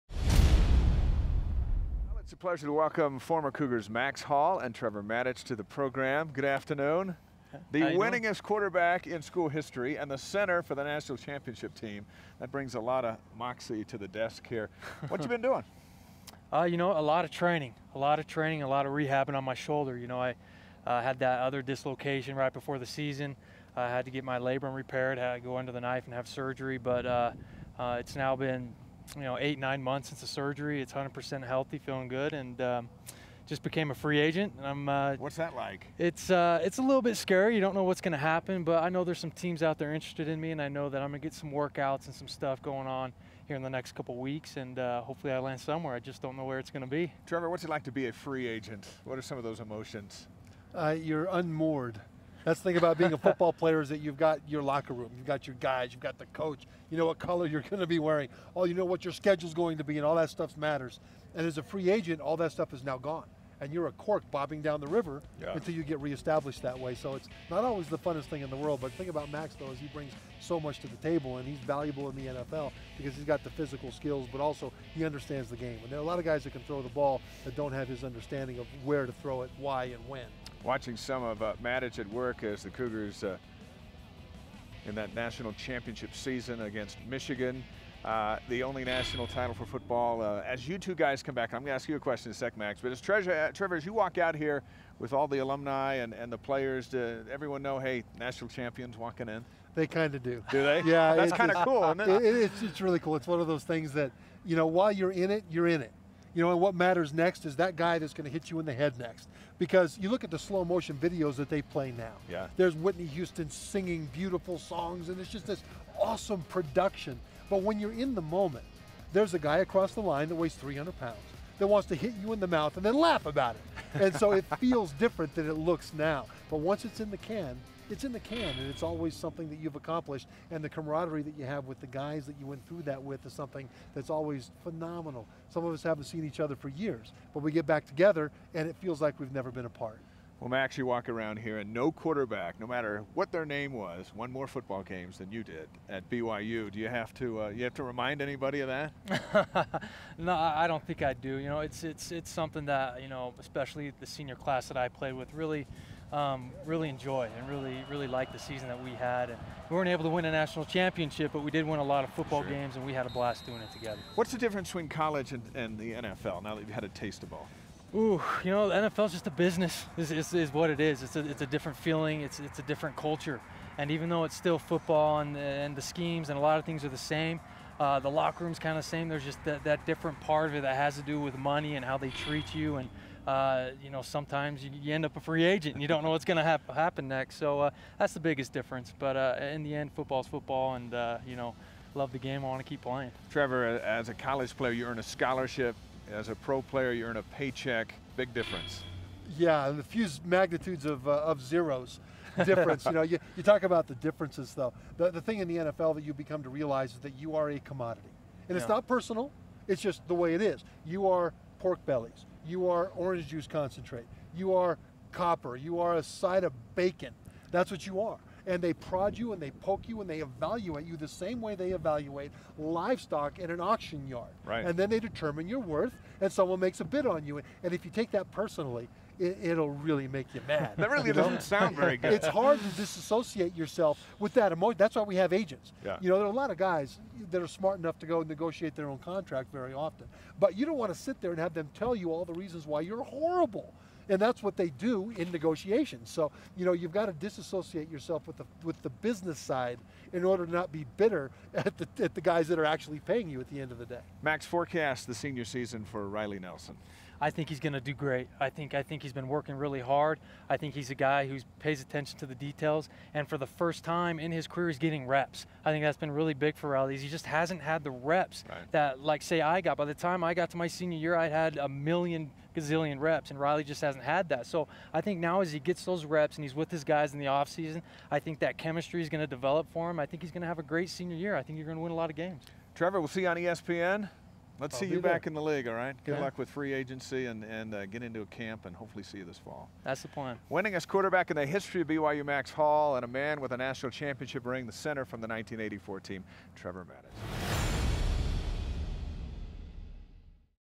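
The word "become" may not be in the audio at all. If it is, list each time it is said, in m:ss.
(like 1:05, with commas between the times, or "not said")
3:26.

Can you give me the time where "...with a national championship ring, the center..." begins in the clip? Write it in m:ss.
4:53.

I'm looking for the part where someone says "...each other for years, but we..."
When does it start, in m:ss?
2:16.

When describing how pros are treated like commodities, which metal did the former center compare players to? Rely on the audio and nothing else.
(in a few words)
copper.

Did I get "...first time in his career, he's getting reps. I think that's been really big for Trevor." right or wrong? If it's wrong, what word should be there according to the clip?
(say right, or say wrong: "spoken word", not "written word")
wrong: "Riley", not "Trevor".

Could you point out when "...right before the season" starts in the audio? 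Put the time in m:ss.
0:22.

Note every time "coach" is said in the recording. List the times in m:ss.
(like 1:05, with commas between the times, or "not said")
0:56.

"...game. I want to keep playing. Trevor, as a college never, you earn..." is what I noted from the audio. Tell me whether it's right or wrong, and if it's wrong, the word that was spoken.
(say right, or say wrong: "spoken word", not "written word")
wrong: "player", not "never".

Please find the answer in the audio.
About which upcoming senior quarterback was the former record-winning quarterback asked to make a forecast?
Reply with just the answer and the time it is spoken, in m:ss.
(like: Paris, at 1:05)
Riley Nelson, at 4:16.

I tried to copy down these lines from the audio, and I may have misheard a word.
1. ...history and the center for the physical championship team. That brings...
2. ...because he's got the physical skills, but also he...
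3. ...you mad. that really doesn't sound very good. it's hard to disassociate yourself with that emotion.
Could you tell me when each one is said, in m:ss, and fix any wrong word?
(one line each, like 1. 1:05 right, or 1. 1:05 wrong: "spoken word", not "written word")
1. 0:09 wrong: "national", not "physical"
2. 1:12 right
3. 3:50 right.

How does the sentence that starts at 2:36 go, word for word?
Um, really enjoy and really really liked the season that we had.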